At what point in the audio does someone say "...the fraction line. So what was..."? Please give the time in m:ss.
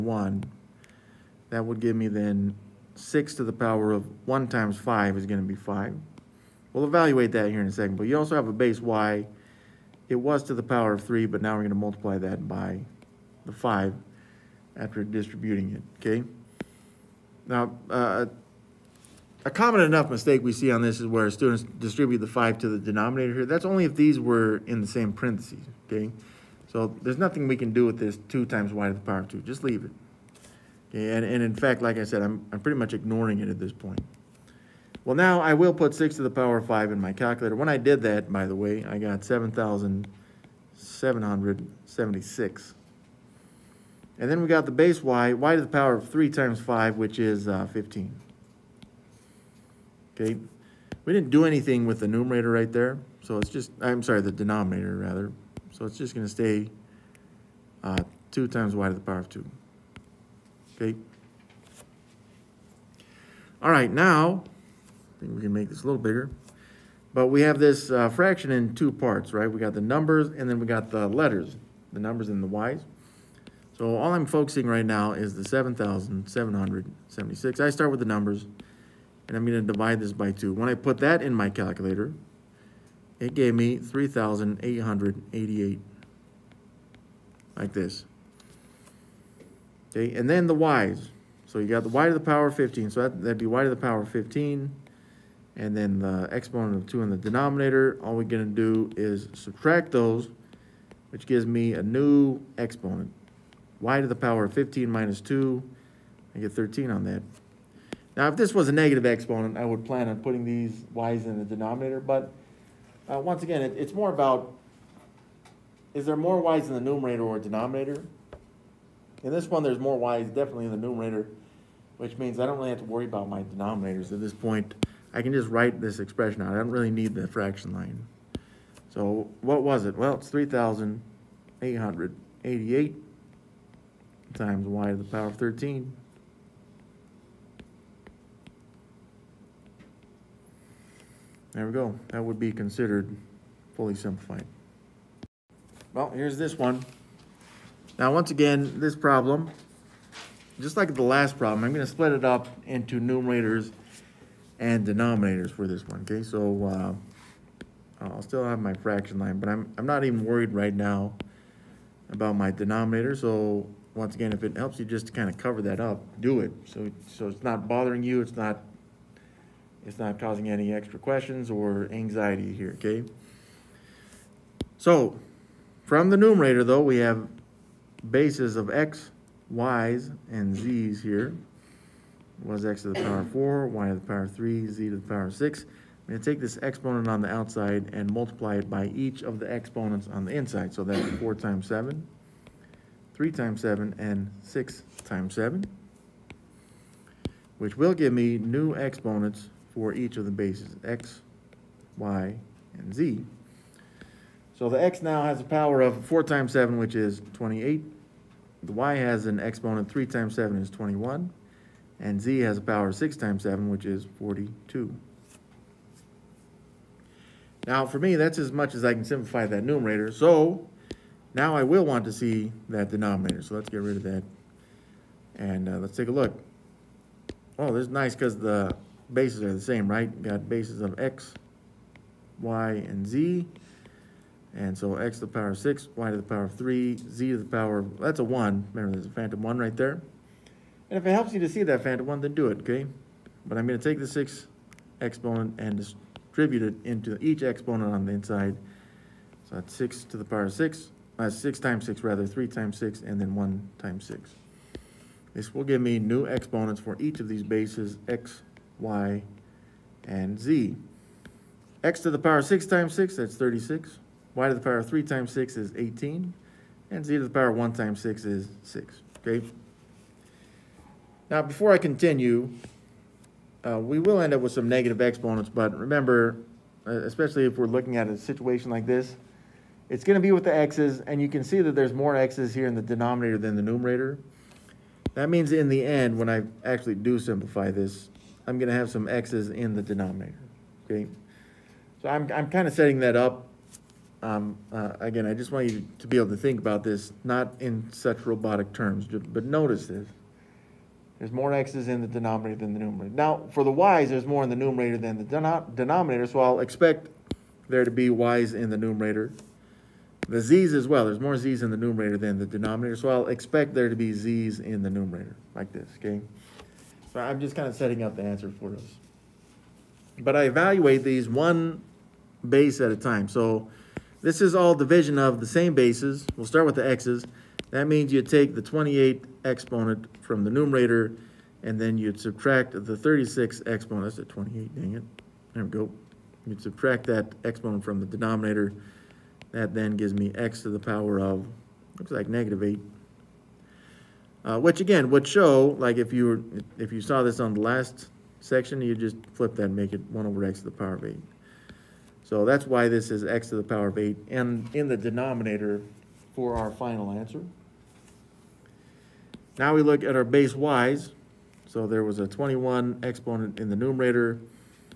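2:07.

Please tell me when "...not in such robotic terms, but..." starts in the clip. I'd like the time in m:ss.
4:57.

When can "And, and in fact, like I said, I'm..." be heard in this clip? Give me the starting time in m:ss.
0:30.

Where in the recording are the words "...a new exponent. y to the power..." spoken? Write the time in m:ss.
1:41.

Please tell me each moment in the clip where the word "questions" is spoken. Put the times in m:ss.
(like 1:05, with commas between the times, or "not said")
2:50.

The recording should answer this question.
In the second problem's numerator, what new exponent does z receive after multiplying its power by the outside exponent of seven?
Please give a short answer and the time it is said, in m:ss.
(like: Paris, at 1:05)
42, at 3:34.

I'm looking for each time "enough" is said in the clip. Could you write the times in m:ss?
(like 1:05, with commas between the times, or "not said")
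0:19.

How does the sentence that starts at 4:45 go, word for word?
That means in the end, when I actually do simplify this, I'm going to have some x's in the denominator, okay?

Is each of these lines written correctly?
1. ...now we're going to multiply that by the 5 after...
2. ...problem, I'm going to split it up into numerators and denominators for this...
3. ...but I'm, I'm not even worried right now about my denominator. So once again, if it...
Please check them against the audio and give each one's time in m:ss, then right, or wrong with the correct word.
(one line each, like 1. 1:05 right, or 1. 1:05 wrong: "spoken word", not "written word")
1. 0:11 right
2. 2:31 right
3. 2:39 right.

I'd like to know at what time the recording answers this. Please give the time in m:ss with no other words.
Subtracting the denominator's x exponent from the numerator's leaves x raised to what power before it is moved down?
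5:42.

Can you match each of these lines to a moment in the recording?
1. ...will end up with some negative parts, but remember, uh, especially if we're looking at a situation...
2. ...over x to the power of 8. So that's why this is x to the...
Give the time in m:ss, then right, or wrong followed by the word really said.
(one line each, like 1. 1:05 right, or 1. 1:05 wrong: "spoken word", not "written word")
1. 4:33 wrong: "exponents", not "parts"
2. 5:50 right.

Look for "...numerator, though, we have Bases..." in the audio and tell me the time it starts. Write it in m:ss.
2:56.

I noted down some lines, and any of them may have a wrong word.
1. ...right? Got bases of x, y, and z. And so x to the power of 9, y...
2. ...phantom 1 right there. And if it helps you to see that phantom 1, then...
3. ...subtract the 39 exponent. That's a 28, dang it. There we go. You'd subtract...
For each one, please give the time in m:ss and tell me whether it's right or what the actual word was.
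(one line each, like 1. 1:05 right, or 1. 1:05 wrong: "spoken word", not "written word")
1. 3:49 wrong: "6", not "9"
2. 3:59 right
3. 5:32 wrong: "36", not "39".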